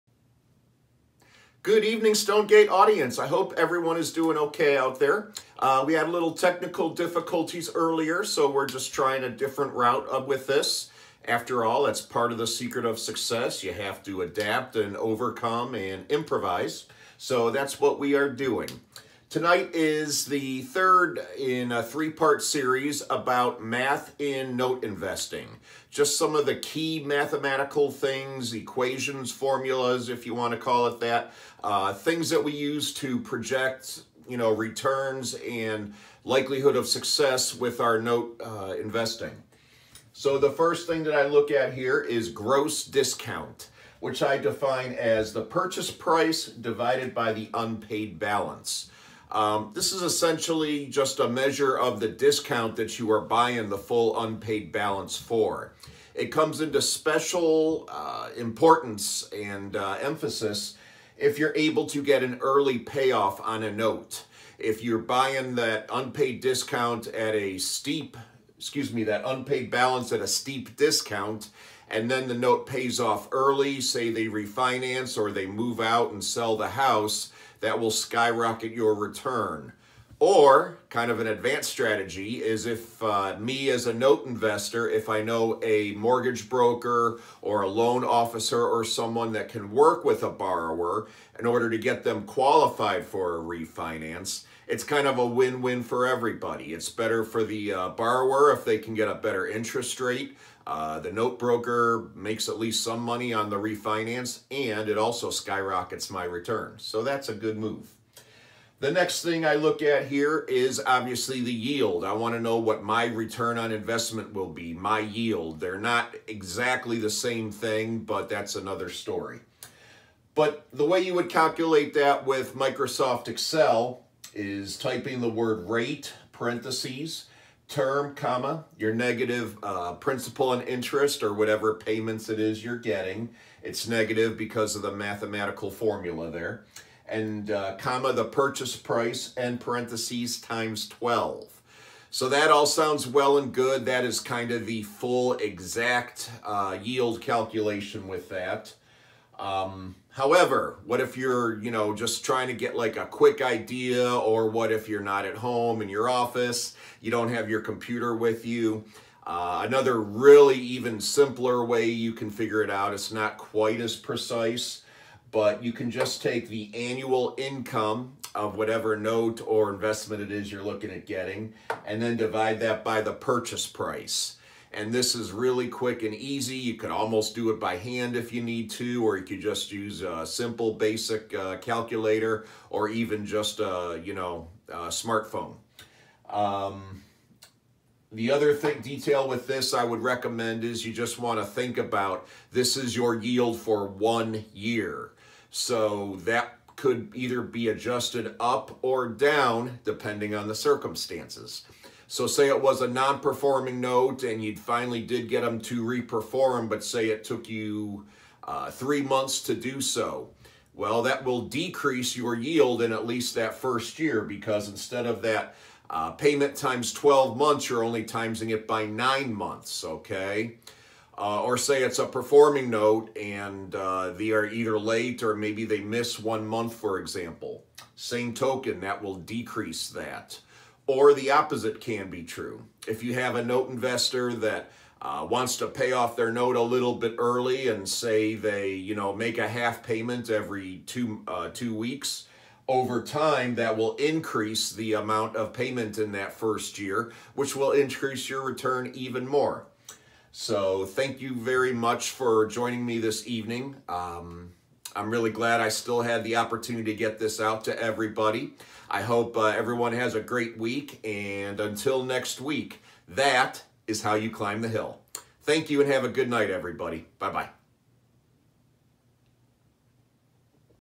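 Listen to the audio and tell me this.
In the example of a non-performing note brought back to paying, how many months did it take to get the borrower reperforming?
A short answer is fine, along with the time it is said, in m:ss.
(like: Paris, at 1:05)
3, at 3:28.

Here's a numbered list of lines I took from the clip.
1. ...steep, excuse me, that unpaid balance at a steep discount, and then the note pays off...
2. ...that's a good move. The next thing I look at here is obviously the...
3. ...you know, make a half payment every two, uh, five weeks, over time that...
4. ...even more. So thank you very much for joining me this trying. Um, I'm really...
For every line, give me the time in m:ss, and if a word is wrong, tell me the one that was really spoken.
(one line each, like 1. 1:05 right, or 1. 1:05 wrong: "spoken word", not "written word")
1. 1:07 right
2. 1:47 right
3. 3:58 wrong: "two", not "five"
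4. 4:08 wrong: "evening", not "trying".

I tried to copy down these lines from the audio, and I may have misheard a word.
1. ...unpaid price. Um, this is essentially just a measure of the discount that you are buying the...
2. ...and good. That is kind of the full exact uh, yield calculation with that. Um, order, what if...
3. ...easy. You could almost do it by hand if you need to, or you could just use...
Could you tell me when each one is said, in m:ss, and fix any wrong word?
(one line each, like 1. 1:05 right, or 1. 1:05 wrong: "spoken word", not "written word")
1. 0:47 wrong: "balance", not "price"
2. 2:23 wrong: "however", not "order"
3. 2:56 right.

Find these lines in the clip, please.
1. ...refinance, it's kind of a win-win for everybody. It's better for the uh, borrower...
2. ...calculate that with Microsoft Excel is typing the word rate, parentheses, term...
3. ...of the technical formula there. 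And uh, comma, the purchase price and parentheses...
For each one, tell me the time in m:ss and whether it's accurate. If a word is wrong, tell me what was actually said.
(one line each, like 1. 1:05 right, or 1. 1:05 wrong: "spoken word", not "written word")
1. 1:33 right
2. 2:01 right
3. 2:14 wrong: "mathematical", not "technical".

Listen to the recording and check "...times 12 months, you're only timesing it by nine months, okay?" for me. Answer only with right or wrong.
right.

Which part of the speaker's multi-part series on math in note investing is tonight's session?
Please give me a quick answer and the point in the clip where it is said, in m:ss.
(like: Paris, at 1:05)
third, at 0:20.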